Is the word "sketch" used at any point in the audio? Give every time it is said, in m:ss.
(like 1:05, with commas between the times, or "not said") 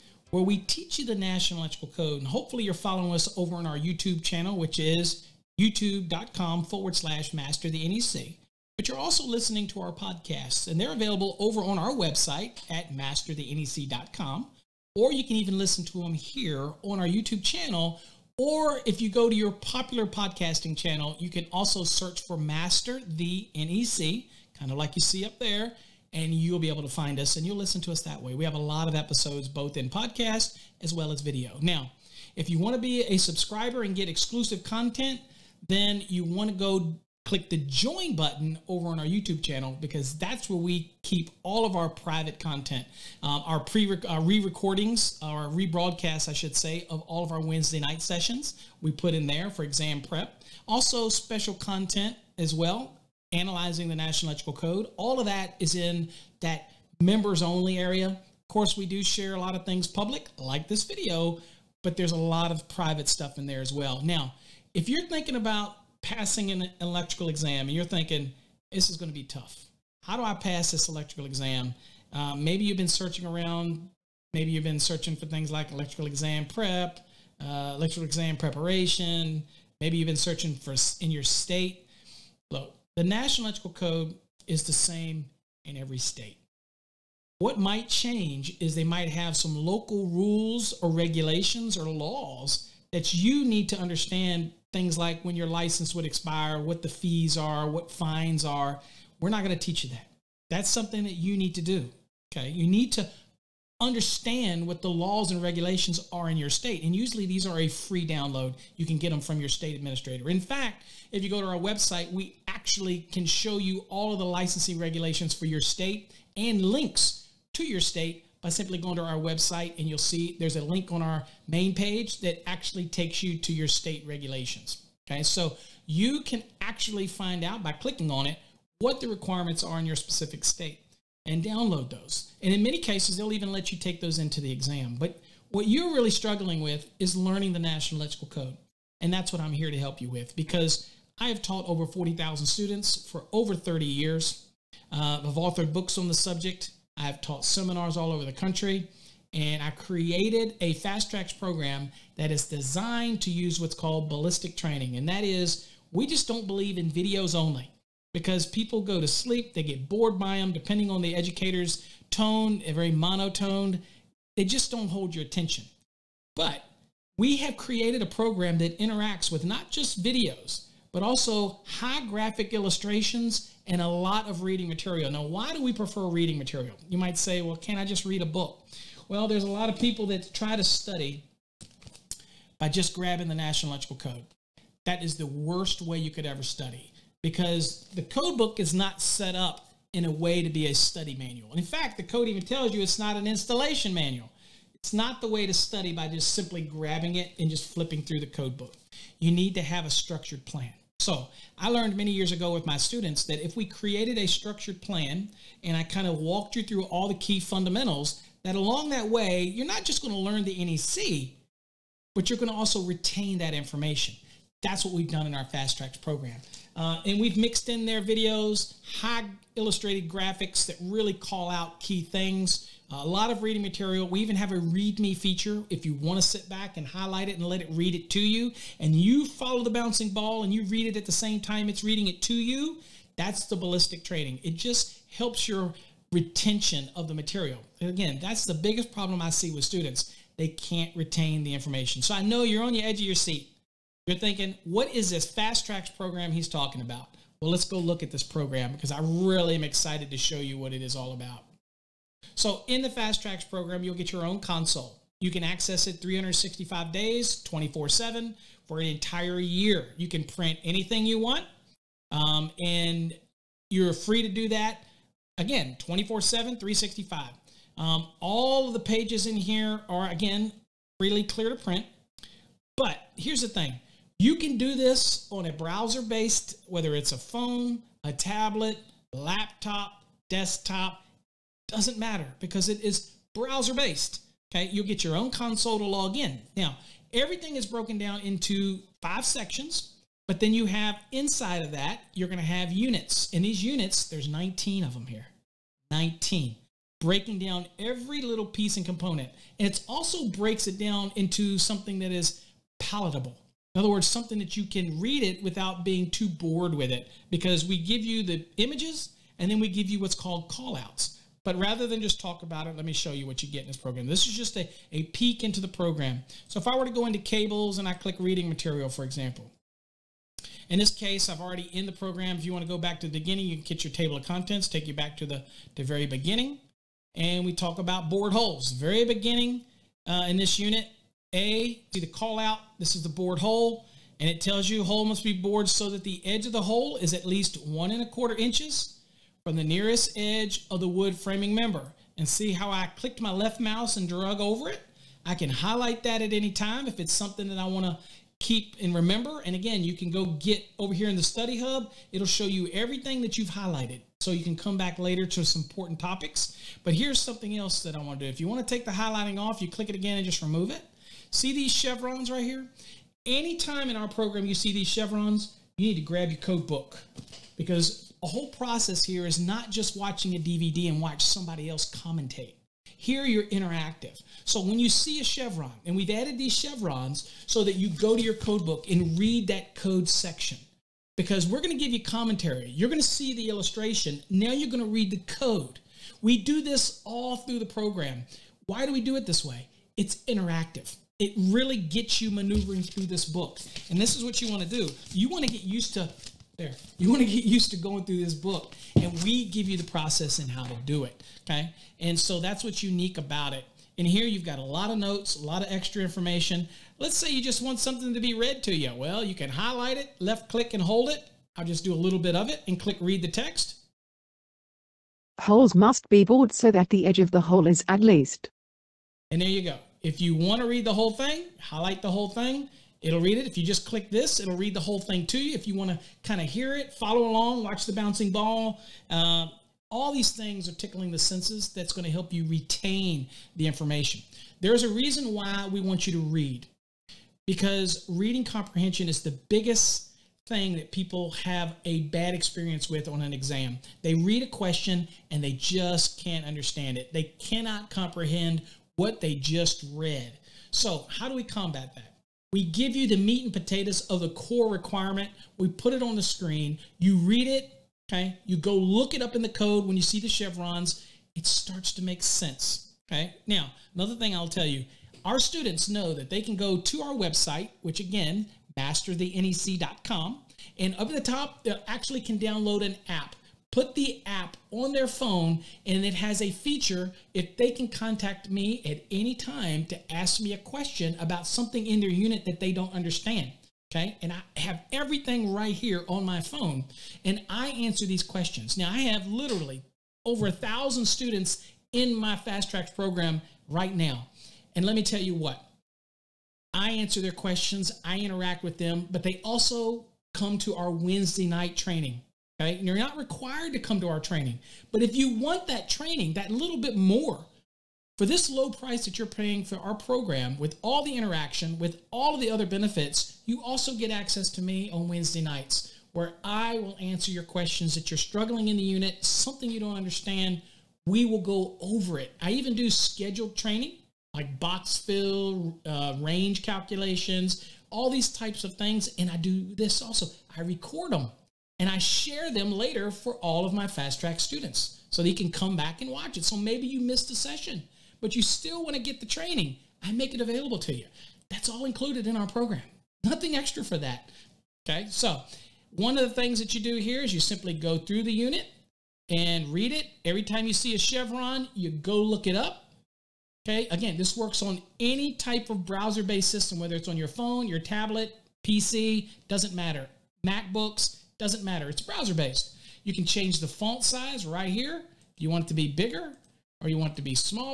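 not said.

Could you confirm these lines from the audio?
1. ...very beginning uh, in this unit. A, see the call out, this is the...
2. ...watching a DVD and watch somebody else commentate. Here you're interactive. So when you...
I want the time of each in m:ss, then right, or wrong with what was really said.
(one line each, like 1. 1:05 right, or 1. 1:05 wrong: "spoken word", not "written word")
1. 5:28 right
2. 6:09 right.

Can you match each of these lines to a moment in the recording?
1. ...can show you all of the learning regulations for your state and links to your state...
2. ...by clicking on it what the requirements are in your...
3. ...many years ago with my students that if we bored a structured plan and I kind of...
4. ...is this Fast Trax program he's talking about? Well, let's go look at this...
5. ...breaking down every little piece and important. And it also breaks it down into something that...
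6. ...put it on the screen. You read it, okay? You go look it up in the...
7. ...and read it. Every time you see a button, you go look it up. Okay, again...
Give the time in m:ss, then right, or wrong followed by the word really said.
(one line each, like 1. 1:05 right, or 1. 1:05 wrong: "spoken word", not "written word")
1. 1:53 wrong: "licensing", not "learning"
2. 2:07 right
3. 3:21 wrong: "created", not "bored"
4. 4:04 right
5. 4:56 wrong: "component", not "important"
6. 7:35 right
7. 9:09 wrong: "chevron", not "button".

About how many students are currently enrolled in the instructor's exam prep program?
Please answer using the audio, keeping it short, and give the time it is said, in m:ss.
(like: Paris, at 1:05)
over a thousand, at 8:10.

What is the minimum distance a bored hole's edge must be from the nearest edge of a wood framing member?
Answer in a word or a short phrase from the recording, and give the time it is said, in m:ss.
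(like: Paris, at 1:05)
1 1/4 inches, at 5:37.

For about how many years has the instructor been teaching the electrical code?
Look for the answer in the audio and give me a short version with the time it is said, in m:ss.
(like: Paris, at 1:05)
30, at 2:23.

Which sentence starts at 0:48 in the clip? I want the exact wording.
We put in there for exam prep, also special content as well analyzing the National Electrical Code.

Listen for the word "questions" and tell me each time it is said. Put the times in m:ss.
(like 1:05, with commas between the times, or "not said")
7:24, 8:00, 8:08, 8:17, 8:37.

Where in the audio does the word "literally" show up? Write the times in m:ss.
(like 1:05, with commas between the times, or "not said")
8:09.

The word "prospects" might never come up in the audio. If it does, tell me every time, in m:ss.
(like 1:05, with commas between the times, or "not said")
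not said.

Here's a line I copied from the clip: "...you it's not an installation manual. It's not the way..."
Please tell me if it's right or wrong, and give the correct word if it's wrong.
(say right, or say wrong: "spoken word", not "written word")
right.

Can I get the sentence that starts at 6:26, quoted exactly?
We do this all through the program.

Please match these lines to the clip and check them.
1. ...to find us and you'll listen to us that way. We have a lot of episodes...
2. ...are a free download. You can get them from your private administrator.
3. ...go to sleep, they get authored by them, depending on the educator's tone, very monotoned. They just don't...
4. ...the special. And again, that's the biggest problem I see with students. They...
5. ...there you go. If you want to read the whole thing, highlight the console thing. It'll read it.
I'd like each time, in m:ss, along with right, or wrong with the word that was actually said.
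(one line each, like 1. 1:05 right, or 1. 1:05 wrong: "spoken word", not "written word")
1. 0:26 right
2. 1:47 wrong: "state", not "private"
3. 2:38 wrong: "bored", not "authored"
4. 3:57 wrong: "material", not "special"
5. 6:59 wrong: "whole", not "console".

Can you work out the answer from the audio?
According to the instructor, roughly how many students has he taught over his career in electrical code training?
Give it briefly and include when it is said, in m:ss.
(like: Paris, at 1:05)
40,000, at 2:21.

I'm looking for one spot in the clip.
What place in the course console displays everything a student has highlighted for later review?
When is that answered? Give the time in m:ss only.
5:51.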